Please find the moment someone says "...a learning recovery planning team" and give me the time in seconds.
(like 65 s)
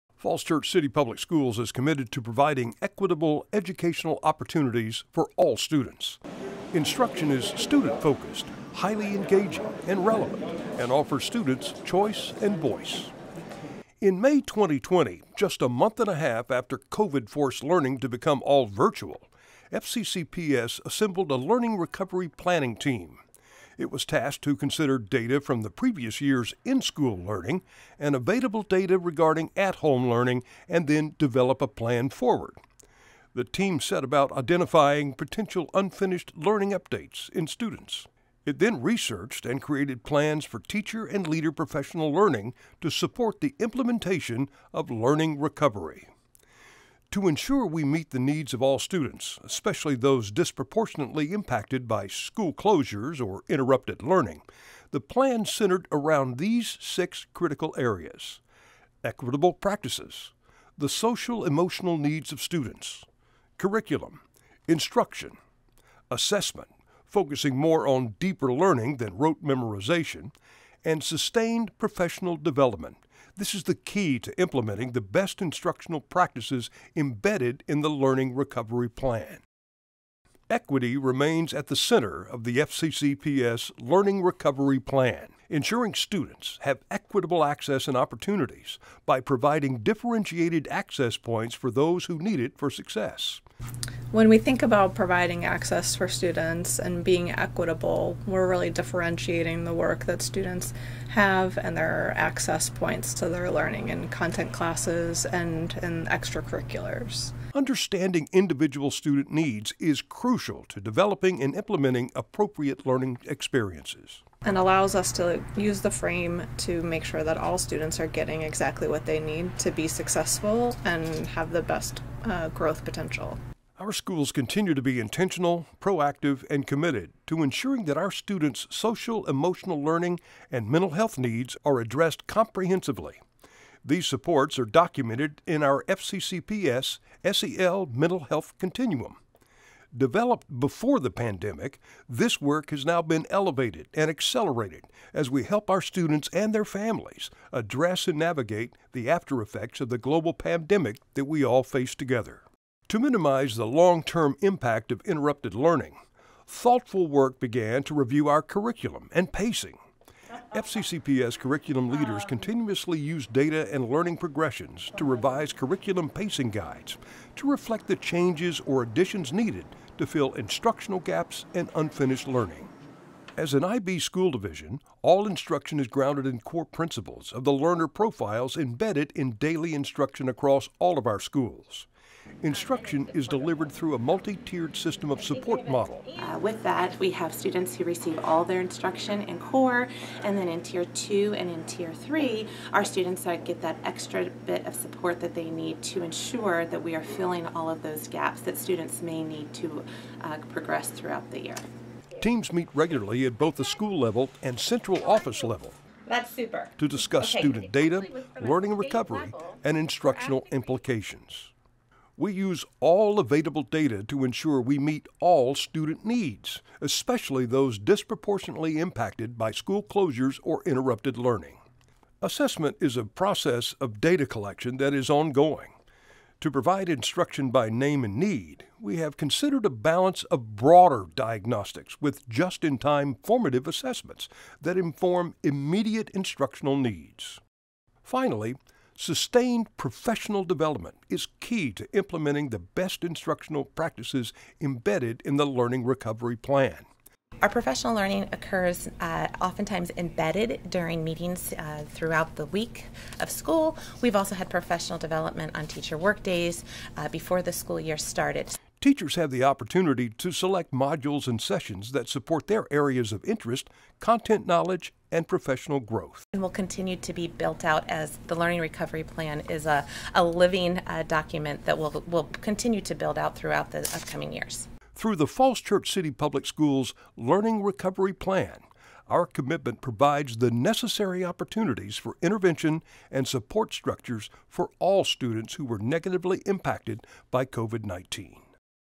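21 s.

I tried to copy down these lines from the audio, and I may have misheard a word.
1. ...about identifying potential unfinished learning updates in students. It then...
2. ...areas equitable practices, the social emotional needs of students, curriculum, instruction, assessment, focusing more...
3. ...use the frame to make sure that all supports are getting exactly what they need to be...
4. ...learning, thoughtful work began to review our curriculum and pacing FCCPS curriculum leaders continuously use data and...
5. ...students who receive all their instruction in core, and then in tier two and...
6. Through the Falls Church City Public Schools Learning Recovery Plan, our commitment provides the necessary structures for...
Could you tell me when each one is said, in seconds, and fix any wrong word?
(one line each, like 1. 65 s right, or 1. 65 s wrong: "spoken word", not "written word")
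1. 34 s right
2. 57 s right
3. 115 s wrong: "students", not "supports"
4. 155 s right
5. 187 s right
6. 275 s wrong: "opportunities", not "structures".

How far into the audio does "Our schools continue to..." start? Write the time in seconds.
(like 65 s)
123 s.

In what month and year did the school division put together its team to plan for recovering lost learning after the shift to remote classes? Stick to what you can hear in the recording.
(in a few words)
May 2020.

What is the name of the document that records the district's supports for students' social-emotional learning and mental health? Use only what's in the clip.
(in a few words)
FCCPS SEL Mental Health Continuum.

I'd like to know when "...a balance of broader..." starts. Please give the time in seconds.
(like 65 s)
229 s.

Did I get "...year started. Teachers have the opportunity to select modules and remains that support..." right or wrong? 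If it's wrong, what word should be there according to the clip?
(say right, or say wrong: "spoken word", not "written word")
wrong: "sessions", not "remains".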